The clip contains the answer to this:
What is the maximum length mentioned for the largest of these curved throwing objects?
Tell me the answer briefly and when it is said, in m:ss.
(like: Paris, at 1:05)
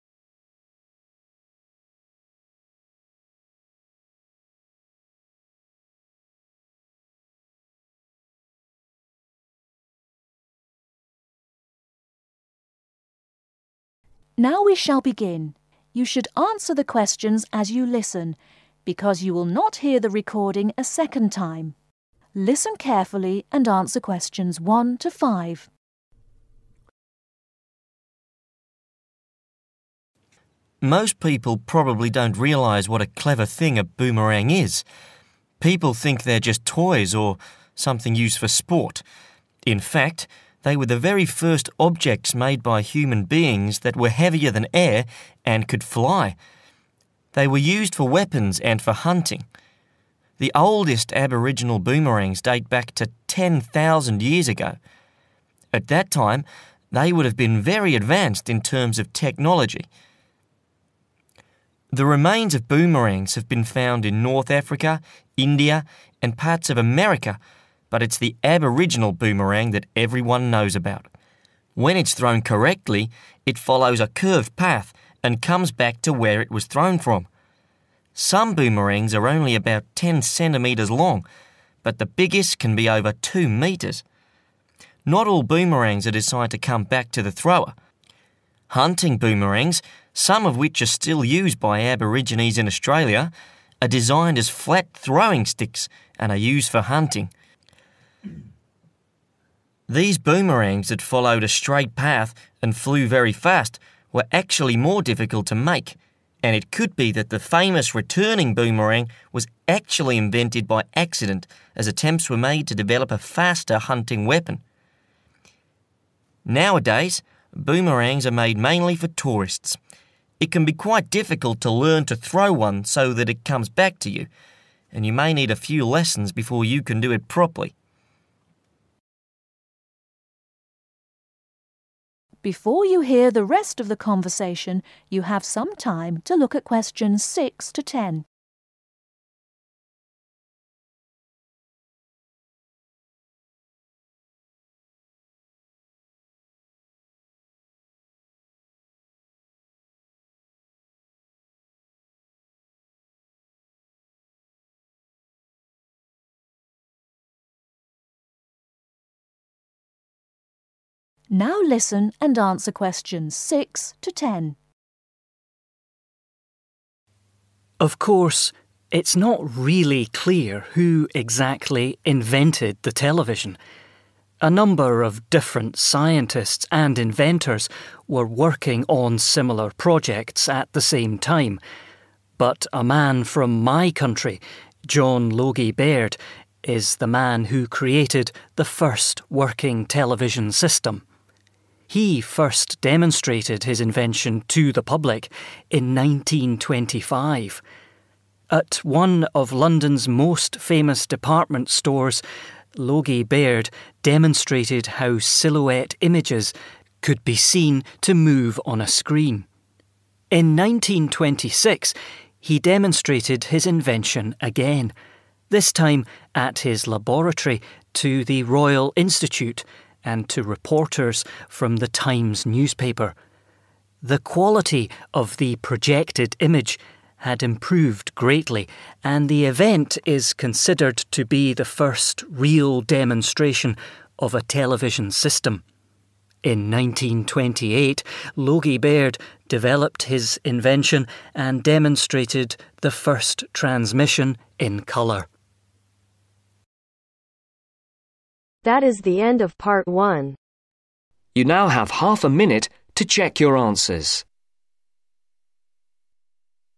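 over 2 metres, at 1:22.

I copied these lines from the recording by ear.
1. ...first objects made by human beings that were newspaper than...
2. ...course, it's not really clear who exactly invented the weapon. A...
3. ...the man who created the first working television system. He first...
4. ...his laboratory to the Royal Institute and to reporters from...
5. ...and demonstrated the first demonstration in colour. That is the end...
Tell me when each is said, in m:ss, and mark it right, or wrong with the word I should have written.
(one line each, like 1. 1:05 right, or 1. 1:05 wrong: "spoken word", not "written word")
1. 0:41 wrong: "heavier", not "newspaper"
2. 2:47 wrong: "television", not "weapon"
3. 3:06 right
4. 3:36 right
5. 4:01 wrong: "transmission", not "demonstration".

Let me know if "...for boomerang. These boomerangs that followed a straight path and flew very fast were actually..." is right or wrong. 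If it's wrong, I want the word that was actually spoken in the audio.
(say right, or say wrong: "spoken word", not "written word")
wrong: "hunting", not "boomerang".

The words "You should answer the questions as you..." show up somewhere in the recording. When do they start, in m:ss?
0:15.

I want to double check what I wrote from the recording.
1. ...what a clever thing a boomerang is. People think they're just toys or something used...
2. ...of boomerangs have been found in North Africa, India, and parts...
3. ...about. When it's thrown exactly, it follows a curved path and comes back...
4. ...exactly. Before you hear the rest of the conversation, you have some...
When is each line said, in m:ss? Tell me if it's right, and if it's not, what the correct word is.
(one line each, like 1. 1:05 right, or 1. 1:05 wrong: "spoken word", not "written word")
1. 0:32 right
2. 1:02 right
3. 1:10 wrong: "correctly", not "exactly"
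4. 2:07 wrong: "properly", not "exactly".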